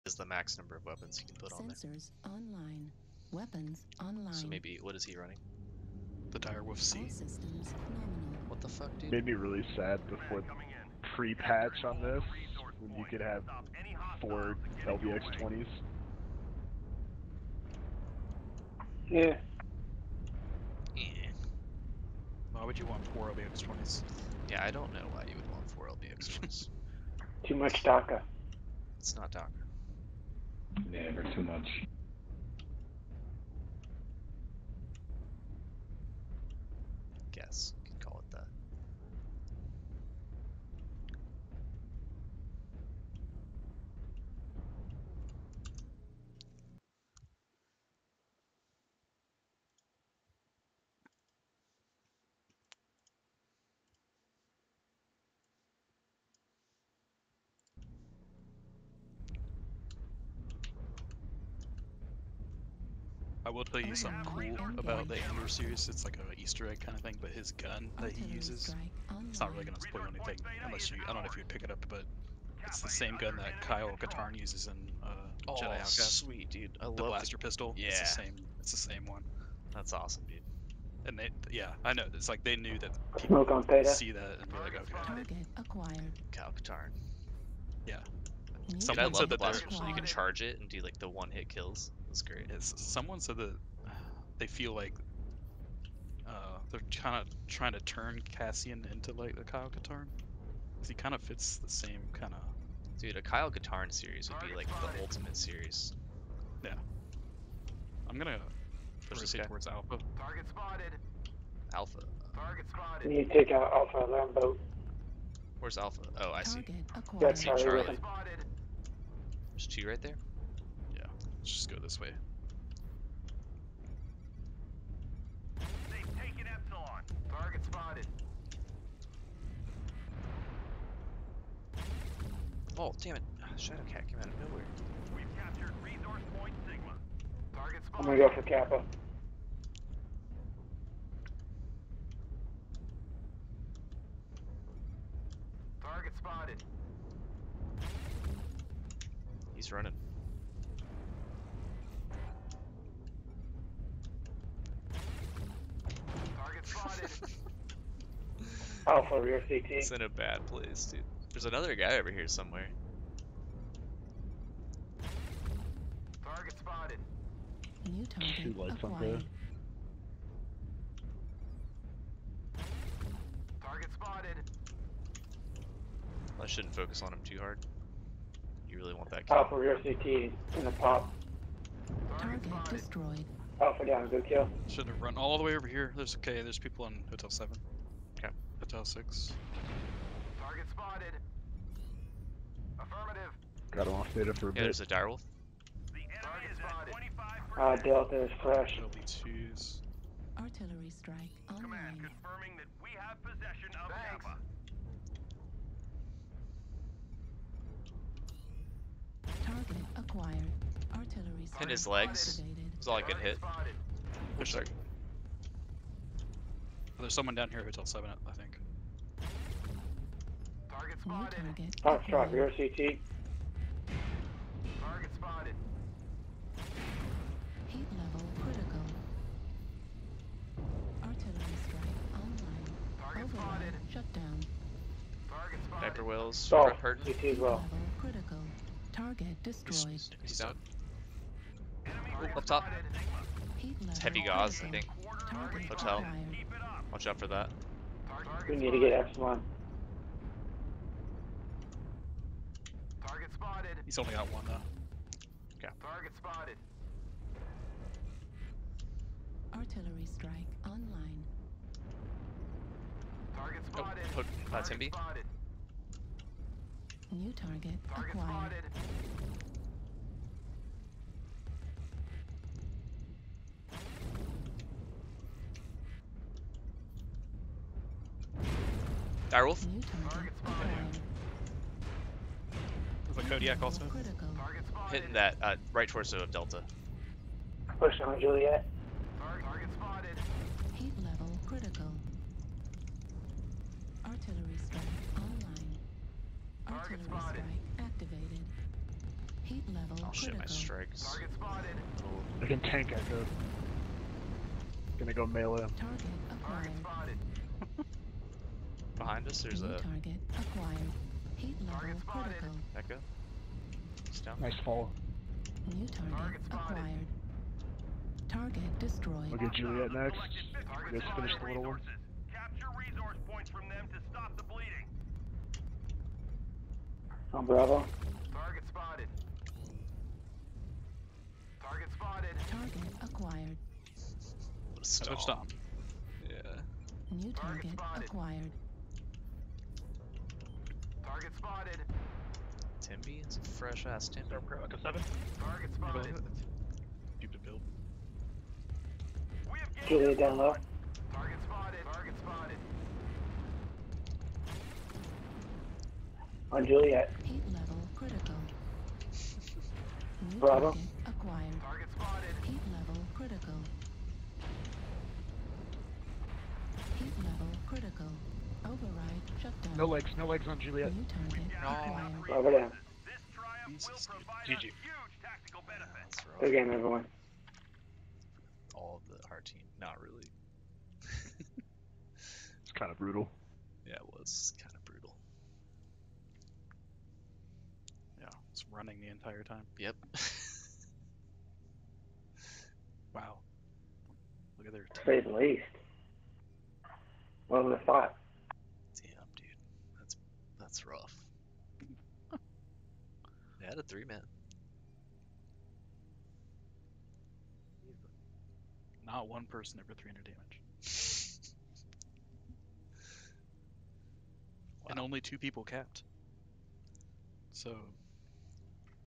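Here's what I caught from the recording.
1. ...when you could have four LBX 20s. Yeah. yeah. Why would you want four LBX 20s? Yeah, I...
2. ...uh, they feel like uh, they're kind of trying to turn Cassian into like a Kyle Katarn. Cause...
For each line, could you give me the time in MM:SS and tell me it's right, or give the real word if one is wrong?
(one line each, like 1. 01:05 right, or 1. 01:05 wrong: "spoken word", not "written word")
1. 00:12 right
2. 01:33 right.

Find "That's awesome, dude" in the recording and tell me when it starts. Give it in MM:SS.
01:19.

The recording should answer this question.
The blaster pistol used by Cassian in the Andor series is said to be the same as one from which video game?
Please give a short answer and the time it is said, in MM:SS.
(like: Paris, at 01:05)
Jedi Outcast, at 01:15.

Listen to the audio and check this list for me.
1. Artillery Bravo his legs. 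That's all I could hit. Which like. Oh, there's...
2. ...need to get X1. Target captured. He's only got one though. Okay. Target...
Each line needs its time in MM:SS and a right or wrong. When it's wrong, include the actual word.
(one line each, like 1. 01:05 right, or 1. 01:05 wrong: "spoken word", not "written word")
1. 03:30 wrong: "Hit", not "Bravo"
2. 04:08 wrong: "spotted", not "captured".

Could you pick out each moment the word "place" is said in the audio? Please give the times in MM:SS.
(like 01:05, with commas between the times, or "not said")
02:40.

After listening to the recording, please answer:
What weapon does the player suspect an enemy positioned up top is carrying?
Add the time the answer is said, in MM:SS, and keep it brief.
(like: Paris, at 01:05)
Heavy gauss, at 04:03.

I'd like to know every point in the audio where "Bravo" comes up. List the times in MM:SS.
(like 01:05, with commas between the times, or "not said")
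05:27, 06:00.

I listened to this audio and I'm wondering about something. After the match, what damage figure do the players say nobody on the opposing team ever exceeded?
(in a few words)
300.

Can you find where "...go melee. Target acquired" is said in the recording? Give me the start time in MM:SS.
05:05.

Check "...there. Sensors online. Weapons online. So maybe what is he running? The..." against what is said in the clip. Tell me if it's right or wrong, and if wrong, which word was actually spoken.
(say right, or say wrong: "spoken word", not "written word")
right.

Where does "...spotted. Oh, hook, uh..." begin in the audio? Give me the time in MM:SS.
04:23.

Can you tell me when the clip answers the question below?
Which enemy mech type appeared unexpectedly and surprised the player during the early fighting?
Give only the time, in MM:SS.
02:13.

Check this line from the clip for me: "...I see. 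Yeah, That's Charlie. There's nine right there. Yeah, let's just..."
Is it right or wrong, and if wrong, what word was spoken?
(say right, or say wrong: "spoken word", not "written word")
wrong: "two", not "nine".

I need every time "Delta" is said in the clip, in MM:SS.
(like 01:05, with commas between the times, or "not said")
03:17, 04:46.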